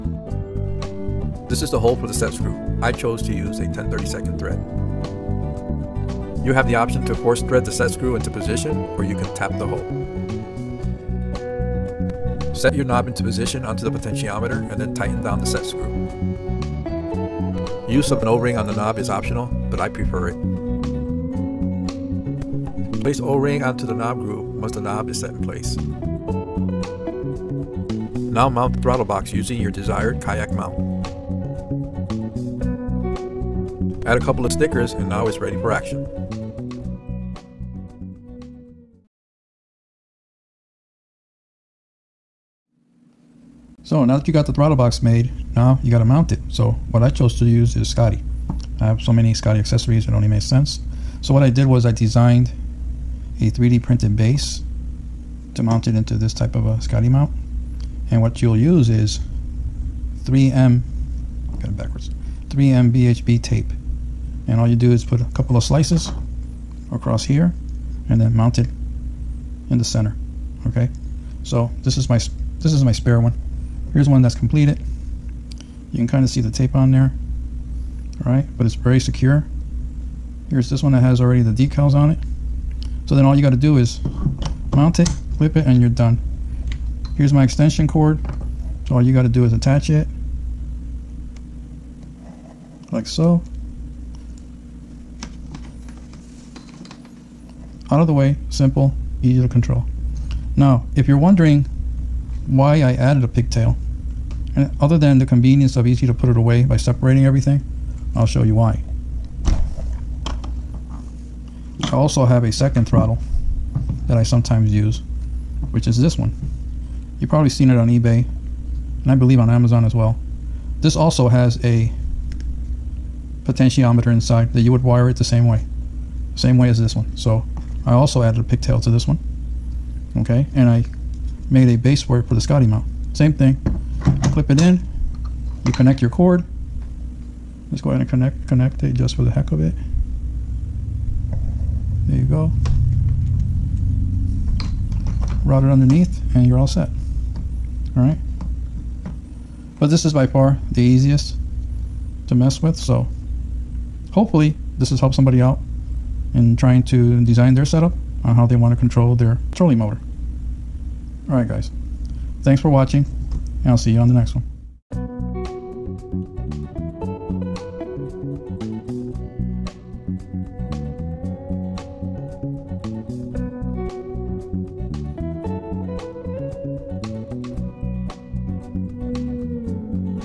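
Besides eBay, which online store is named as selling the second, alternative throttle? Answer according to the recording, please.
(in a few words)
Amazon.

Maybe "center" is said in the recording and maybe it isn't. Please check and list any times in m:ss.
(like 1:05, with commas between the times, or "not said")
1:09.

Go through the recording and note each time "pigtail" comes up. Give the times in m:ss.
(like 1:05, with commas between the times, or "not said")
1:43, 2:08.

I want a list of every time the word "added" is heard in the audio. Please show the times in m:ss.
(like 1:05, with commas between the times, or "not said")
1:42, 2:08.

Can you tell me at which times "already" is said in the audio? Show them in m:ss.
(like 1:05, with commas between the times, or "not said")
1:21.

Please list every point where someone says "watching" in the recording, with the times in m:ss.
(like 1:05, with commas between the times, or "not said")
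2:42.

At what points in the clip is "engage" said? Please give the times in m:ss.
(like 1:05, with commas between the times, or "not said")
not said.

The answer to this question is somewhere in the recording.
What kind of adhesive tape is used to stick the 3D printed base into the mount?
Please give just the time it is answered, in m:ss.
1:02.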